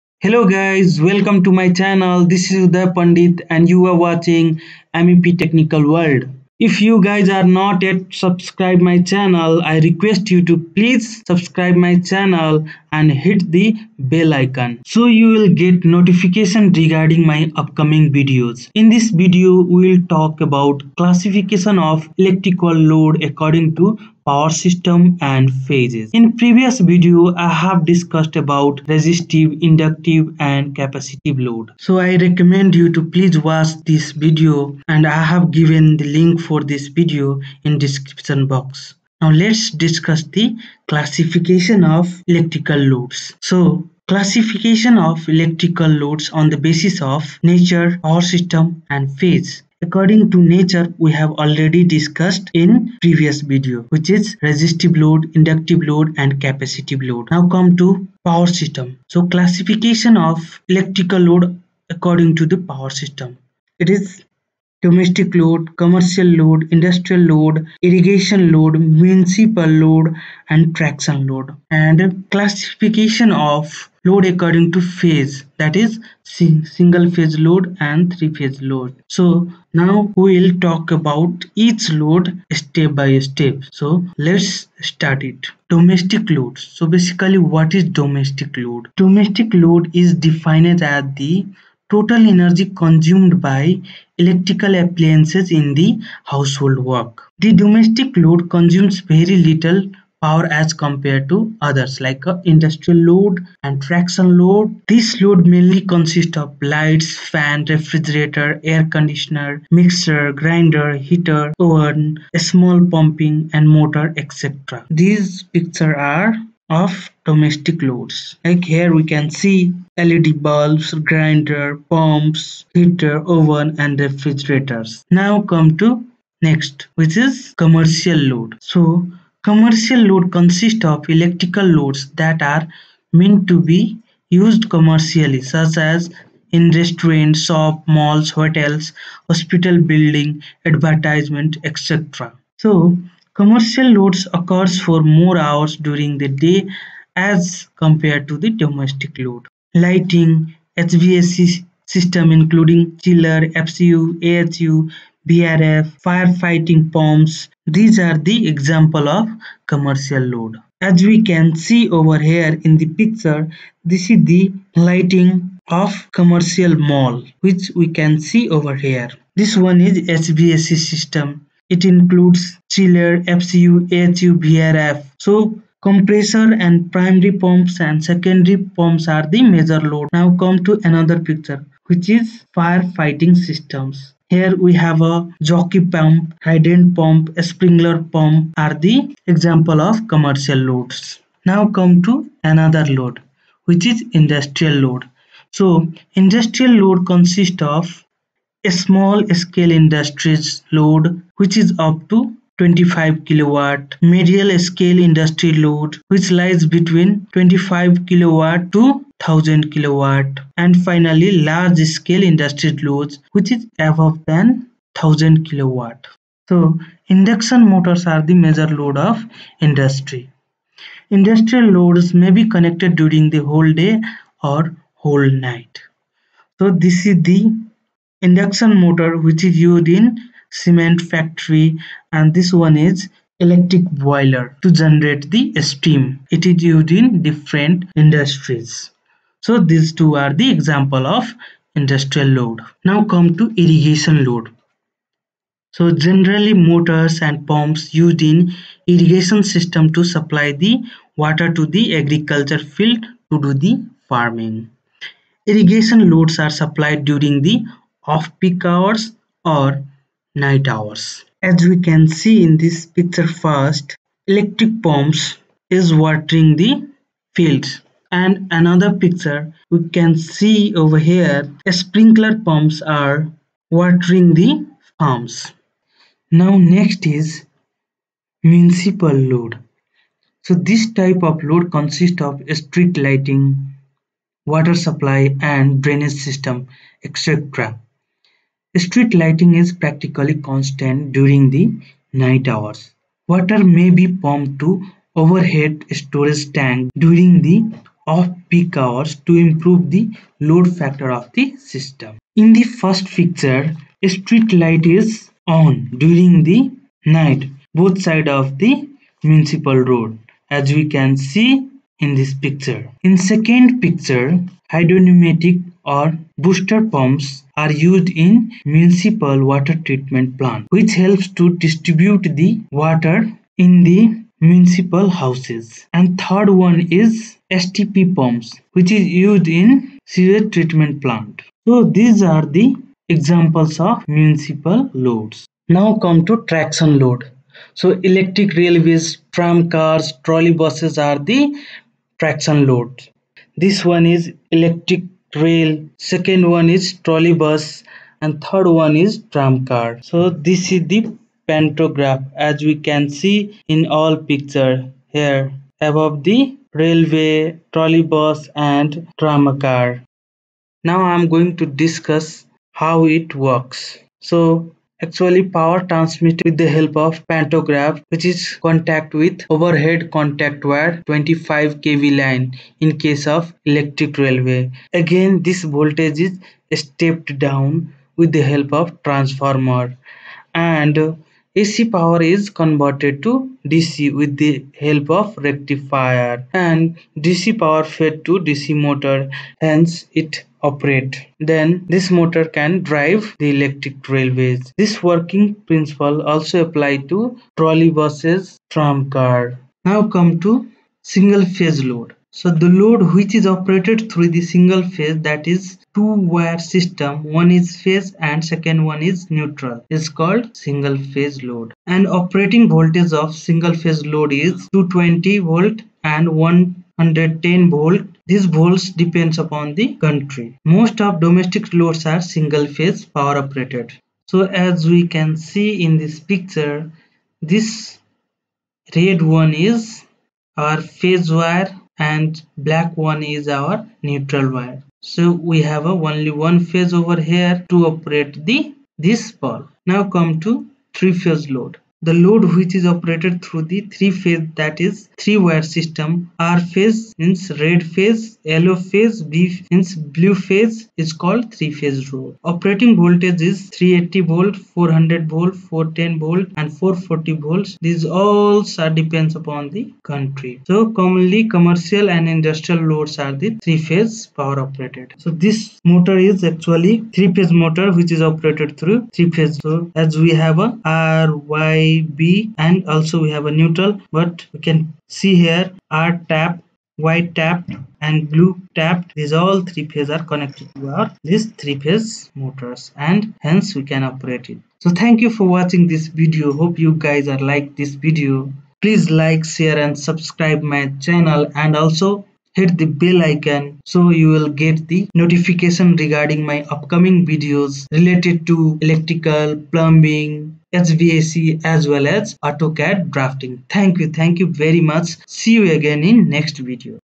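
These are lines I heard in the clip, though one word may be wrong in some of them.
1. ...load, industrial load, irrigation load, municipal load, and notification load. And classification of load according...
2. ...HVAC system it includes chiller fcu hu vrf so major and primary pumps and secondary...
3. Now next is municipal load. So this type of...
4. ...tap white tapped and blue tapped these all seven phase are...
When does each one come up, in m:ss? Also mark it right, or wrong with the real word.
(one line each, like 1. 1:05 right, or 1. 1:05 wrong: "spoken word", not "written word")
1. 1:06 wrong: "traction", not "notification"
2. 2:49 wrong: "compressor", not "major"
3. 4:36 right
4. 7:56 wrong: "three", not "seven".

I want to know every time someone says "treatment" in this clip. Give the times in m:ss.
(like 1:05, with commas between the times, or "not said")
5:19, 5:30.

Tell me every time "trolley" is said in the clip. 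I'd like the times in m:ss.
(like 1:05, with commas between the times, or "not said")
5:40, 5:47, 5:57, 6:37.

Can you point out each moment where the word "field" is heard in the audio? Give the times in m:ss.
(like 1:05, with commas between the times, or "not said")
4:12, 4:27.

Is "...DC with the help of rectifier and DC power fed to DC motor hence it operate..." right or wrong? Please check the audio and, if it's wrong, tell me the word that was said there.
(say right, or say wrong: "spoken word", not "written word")
right.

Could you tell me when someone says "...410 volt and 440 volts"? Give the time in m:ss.
7:35.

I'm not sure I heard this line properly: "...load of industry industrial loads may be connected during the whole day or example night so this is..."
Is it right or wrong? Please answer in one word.
wrong.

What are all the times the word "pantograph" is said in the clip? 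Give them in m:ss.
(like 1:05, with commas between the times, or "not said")
5:51, 6:07.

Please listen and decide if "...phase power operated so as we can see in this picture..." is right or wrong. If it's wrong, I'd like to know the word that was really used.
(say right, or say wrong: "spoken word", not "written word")
right.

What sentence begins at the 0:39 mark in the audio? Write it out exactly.
Now let's discuss the classification of electrical loads.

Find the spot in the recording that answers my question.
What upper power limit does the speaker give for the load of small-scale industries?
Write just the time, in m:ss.
3:21.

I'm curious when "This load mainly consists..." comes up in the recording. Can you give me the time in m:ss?
1:44.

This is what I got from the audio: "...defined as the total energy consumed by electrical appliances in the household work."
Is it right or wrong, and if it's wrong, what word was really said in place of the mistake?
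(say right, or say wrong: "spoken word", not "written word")
right.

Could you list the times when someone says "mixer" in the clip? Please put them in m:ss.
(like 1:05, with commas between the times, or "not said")
1:49.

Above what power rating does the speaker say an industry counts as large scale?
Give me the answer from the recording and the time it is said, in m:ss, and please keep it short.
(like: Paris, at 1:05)
1000 kilowatt, at 3:33.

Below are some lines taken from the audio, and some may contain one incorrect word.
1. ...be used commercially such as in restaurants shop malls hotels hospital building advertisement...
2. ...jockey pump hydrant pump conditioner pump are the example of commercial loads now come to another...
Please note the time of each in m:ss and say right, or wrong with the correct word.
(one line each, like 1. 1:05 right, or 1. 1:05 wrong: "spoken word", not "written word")
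1. 2:13 right
2. 3:05 wrong: "sprinkler", not "conditioner".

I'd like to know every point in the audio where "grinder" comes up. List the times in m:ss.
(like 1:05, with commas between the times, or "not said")
1:50, 2:01.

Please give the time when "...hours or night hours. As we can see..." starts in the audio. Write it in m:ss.
4:18.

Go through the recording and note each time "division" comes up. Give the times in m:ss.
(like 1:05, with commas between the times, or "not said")
not said.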